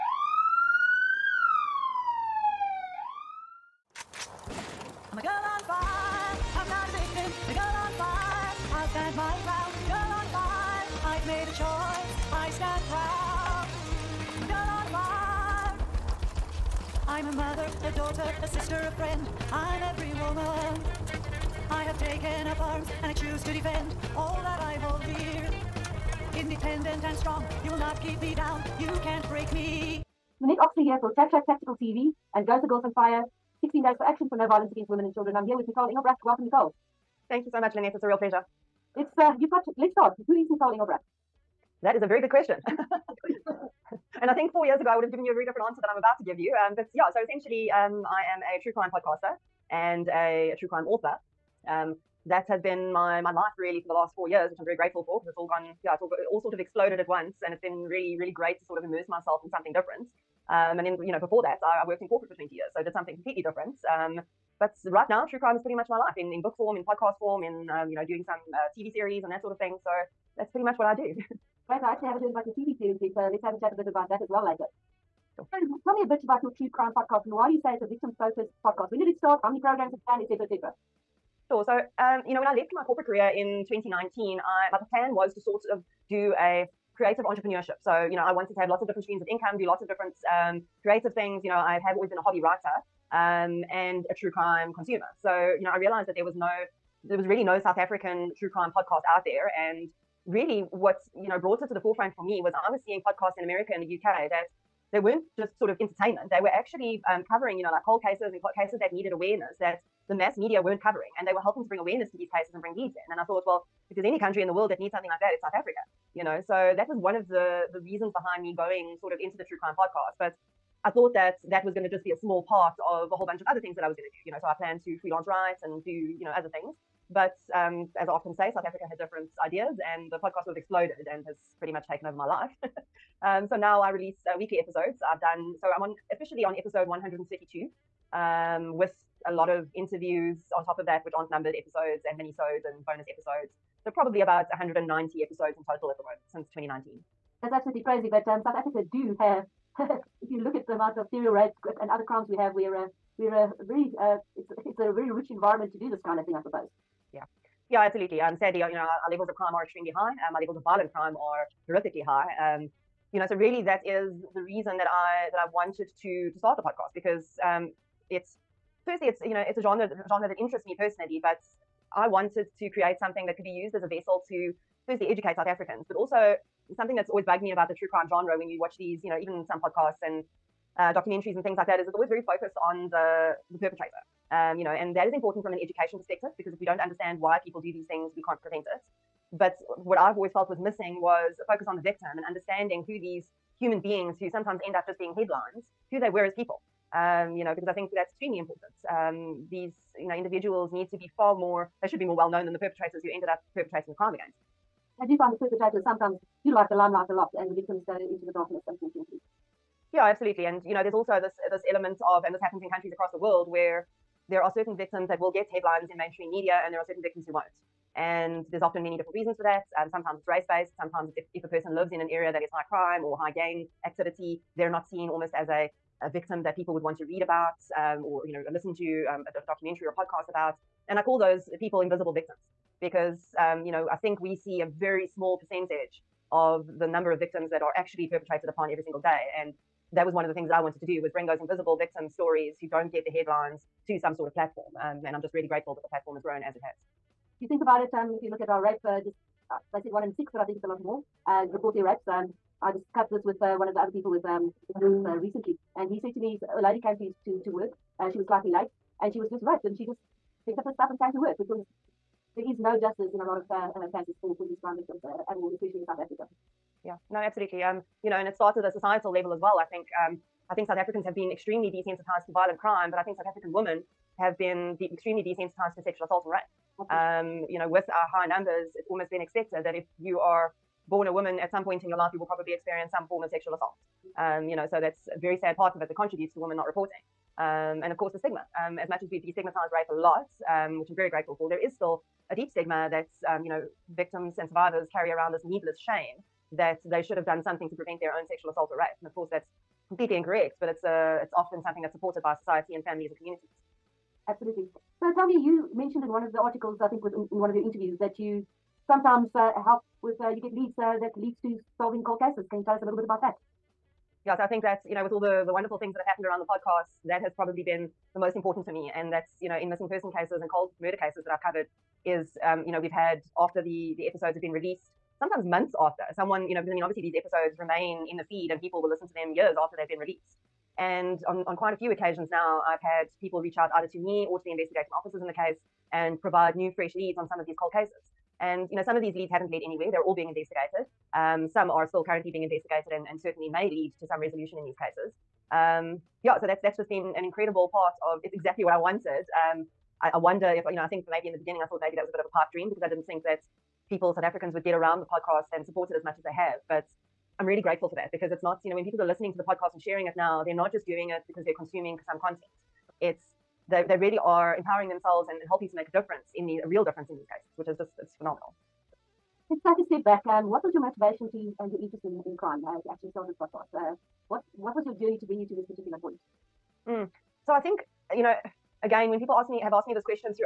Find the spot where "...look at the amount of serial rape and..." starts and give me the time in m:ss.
2:30.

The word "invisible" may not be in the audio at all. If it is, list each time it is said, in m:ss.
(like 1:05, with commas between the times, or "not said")
3:51, 4:01.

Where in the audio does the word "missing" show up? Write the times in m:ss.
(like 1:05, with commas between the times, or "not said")
3:10, 5:19.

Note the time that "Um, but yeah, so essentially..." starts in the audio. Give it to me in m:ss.
0:46.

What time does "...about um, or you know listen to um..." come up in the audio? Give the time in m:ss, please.
3:47.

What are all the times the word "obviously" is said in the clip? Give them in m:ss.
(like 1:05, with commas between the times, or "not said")
5:26.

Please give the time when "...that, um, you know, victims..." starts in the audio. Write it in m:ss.
4:52.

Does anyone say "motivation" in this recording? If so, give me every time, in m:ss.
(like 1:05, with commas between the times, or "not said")
6:10.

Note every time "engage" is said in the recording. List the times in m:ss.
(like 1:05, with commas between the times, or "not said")
not said.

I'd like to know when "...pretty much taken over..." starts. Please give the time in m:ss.
2:11.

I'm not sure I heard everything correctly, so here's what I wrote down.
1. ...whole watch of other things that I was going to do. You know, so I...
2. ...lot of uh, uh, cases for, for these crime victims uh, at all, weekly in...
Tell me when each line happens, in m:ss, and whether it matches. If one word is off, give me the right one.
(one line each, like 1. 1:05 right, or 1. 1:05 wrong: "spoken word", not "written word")
1. 2:03 wrong: "bunch", not "watch"
2. 4:23 wrong: "especially", not "weekly".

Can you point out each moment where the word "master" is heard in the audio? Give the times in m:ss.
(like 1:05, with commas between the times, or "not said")
not said.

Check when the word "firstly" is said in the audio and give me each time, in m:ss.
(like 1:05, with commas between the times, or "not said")
2:48, 2:54.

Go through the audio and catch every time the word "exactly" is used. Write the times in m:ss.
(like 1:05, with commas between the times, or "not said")
5:48.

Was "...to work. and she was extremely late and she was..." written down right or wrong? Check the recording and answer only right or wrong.
wrong.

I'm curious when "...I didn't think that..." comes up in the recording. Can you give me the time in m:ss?
5:52.